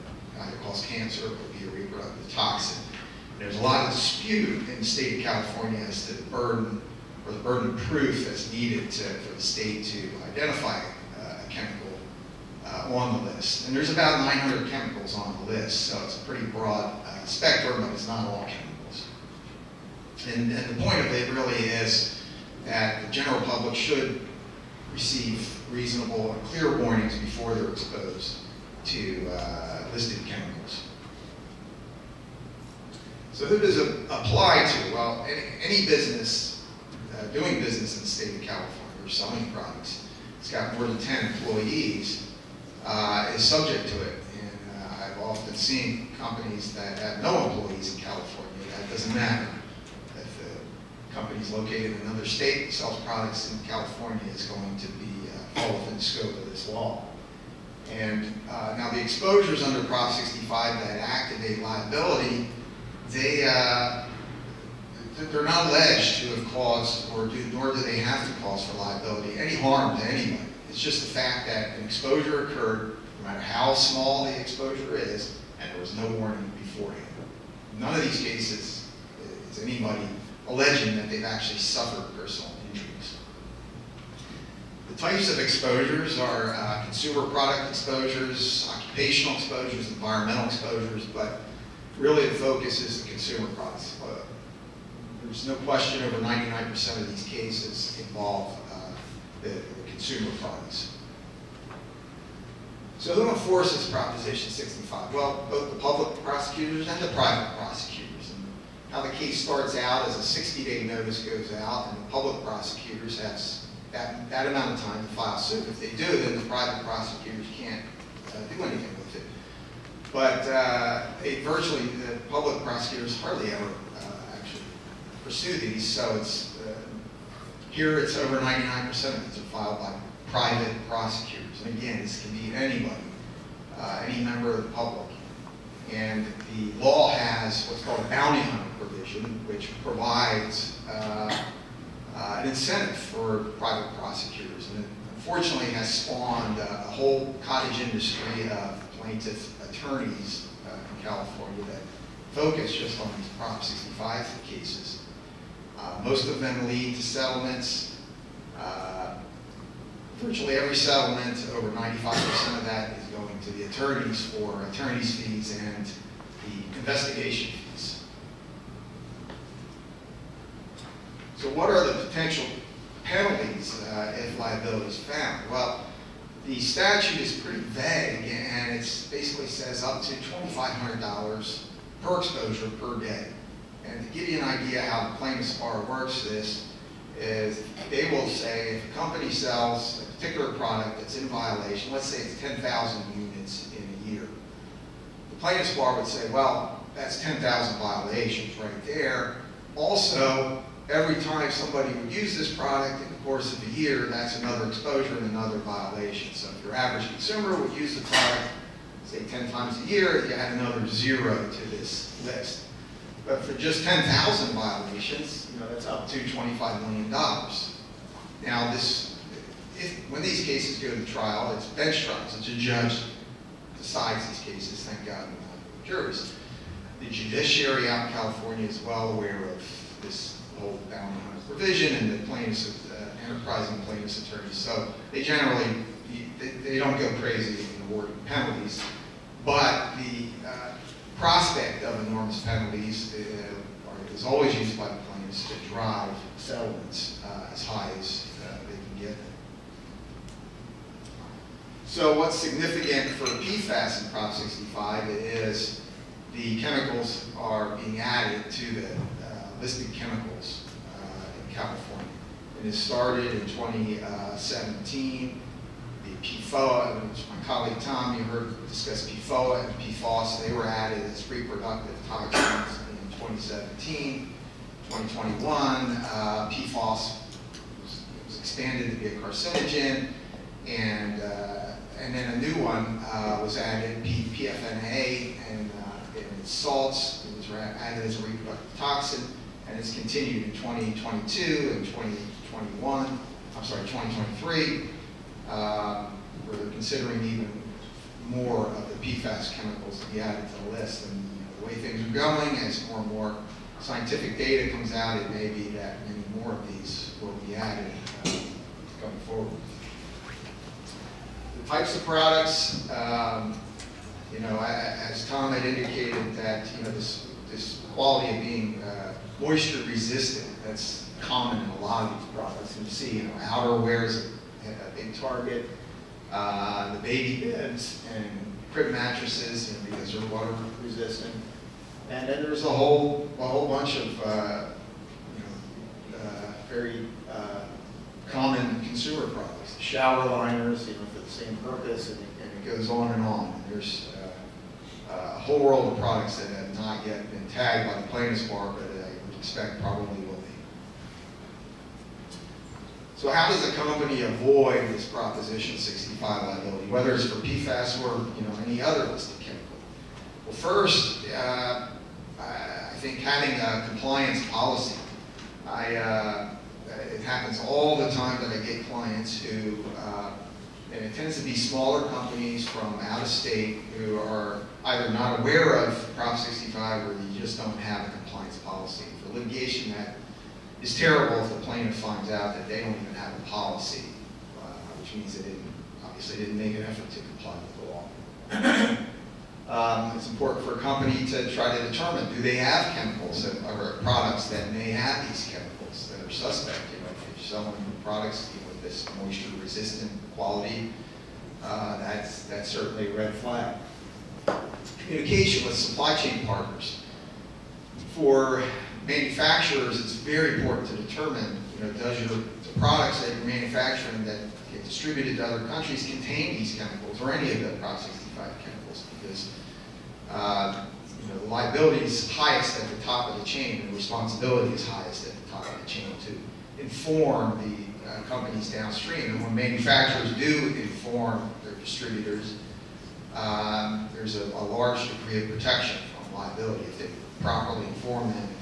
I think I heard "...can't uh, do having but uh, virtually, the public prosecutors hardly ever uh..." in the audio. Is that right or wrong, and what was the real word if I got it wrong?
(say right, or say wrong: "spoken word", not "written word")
wrong: "anything", not "having".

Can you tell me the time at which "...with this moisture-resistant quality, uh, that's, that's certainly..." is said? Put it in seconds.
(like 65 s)
398 s.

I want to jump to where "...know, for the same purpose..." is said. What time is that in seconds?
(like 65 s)
340 s.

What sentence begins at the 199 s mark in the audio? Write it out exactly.
Also, every time somebody would use this product, it course of a year, that's another exposure and another violation.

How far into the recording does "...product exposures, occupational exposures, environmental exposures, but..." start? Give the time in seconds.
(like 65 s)
87 s.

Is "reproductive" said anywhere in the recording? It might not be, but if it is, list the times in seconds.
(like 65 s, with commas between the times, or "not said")
1 s, 271 s, 288 s.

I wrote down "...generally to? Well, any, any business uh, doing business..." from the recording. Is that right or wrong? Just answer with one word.
wrong.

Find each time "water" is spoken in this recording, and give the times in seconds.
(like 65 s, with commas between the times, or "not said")
330 s.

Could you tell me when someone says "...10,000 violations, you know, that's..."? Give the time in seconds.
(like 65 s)
213 s.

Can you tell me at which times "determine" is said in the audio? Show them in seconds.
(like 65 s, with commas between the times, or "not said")
391 s, 410 s.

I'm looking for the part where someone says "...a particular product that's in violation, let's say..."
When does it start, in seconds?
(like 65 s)
190 s.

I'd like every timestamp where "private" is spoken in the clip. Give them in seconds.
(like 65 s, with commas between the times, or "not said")
107 s, 116 s, 130 s, 143 s.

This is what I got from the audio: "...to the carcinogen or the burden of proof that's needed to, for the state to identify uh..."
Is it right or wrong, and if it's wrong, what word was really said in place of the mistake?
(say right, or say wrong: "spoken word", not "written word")
wrong: "burden", not "carcinogen".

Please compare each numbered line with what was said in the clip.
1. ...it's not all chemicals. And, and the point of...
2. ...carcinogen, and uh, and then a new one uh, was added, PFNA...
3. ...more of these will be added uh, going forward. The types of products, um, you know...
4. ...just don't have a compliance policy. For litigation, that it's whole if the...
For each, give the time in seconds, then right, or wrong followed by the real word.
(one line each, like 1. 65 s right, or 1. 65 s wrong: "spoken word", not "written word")
1. 17 s right
2. 279 s right
3. 306 s right
4. 377 s wrong: "terrible", not "whole".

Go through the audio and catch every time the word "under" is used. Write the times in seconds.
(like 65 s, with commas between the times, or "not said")
59 s.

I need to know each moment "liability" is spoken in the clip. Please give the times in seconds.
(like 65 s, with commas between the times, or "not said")
61 s, 68 s, 174 s, 356 s, 421 s, 436 s.